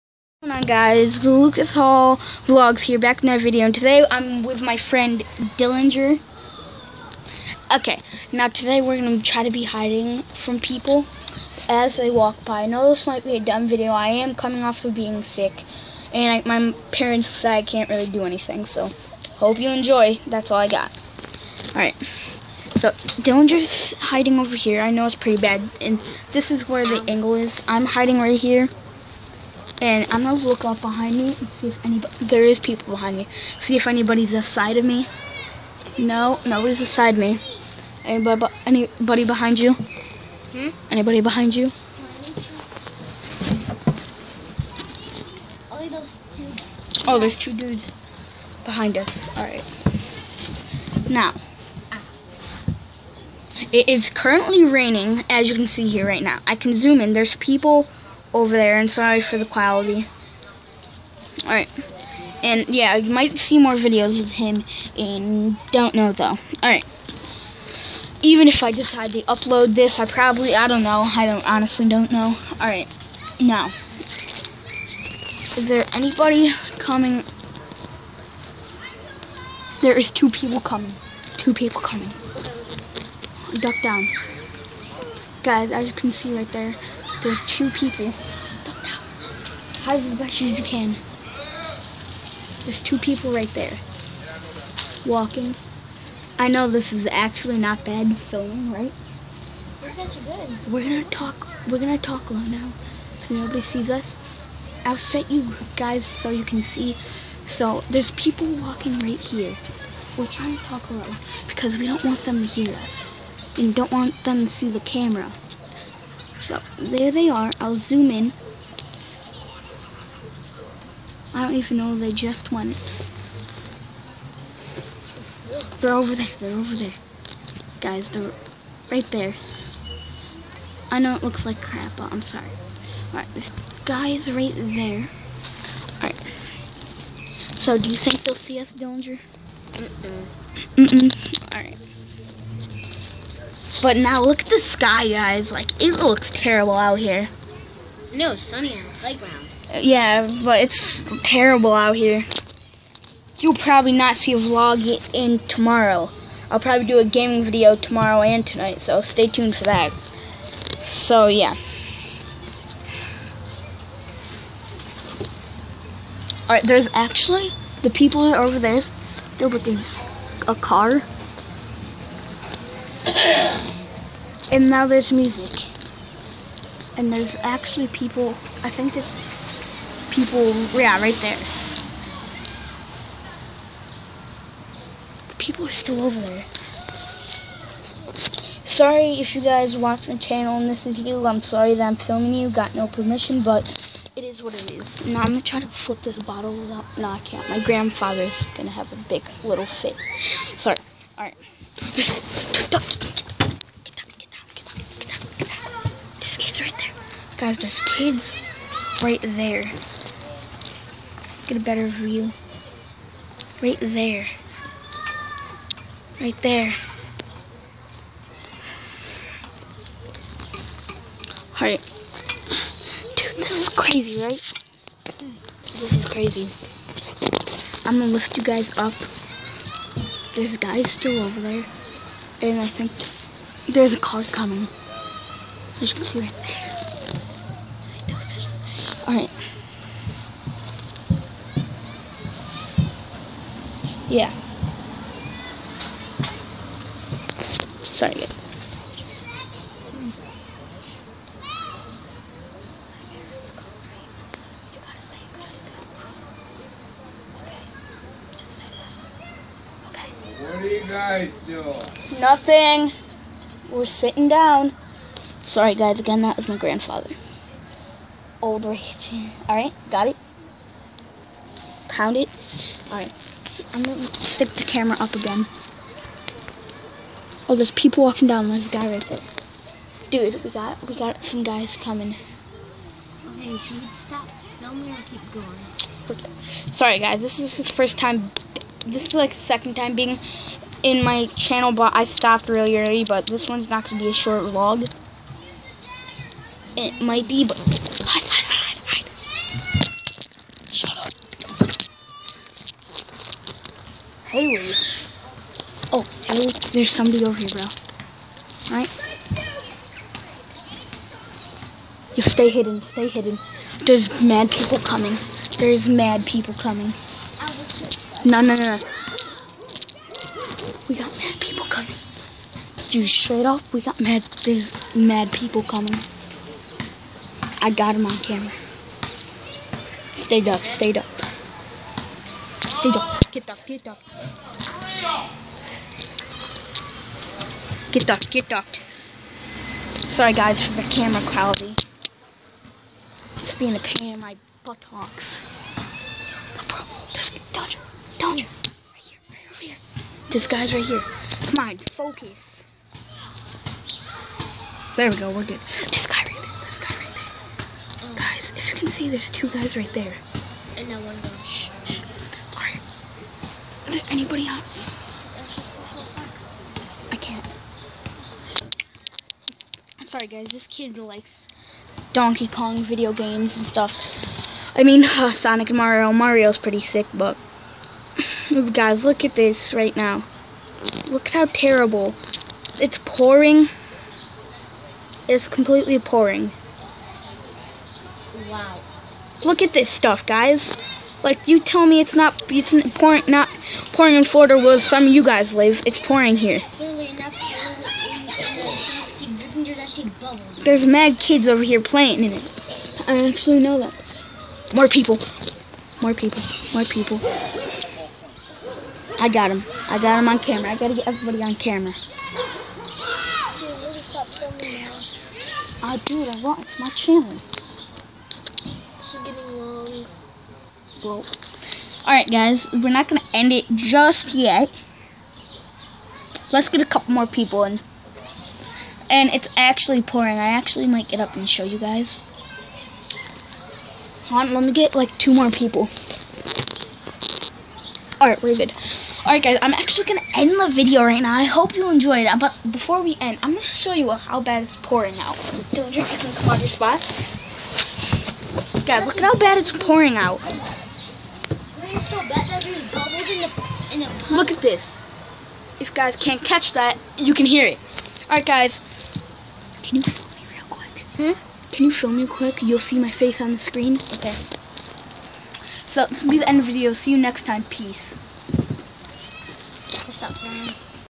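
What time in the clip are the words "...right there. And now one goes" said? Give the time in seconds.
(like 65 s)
359 s.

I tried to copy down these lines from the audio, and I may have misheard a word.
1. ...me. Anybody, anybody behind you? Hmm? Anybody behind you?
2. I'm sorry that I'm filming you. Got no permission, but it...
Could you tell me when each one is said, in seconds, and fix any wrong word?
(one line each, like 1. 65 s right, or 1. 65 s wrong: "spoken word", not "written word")
1. 37 s right
2. 191 s right.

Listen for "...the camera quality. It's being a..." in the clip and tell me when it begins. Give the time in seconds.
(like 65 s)
340 s.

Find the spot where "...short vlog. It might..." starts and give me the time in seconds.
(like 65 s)
294 s.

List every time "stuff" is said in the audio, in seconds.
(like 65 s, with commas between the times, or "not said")
373 s, 389 s.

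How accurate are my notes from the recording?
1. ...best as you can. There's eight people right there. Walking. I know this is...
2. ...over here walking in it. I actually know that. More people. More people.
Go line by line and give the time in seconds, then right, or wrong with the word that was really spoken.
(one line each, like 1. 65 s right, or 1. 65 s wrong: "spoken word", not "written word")
1. 90 s wrong: "two", not "eight"
2. 401 s wrong: "playing", not "walking".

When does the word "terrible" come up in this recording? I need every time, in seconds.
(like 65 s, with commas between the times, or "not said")
146 s, 151 s, 381 s.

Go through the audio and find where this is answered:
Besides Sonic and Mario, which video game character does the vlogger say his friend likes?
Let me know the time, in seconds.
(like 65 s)
372 s.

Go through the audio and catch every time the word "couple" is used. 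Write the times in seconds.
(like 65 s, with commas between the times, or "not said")
426 s.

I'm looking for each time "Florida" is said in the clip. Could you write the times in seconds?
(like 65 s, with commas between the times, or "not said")
394 s.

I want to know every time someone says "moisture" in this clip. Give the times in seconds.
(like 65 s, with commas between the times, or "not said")
not said.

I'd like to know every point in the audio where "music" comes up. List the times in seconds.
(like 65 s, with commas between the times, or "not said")
175 s.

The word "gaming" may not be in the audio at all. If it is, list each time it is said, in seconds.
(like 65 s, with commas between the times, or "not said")
157 s.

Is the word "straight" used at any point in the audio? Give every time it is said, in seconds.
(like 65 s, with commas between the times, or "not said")
323 s.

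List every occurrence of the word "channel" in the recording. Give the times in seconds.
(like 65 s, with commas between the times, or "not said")
190 s, 291 s, 416 s.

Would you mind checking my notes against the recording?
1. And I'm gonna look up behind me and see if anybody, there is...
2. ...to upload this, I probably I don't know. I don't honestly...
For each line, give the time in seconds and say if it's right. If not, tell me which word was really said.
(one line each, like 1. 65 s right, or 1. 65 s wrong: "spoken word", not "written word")
1. 29 s right
2. 69 s right.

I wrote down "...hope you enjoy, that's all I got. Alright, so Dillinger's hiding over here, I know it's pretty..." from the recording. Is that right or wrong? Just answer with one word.
right.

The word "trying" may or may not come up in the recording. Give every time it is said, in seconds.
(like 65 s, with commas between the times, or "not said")
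110 s.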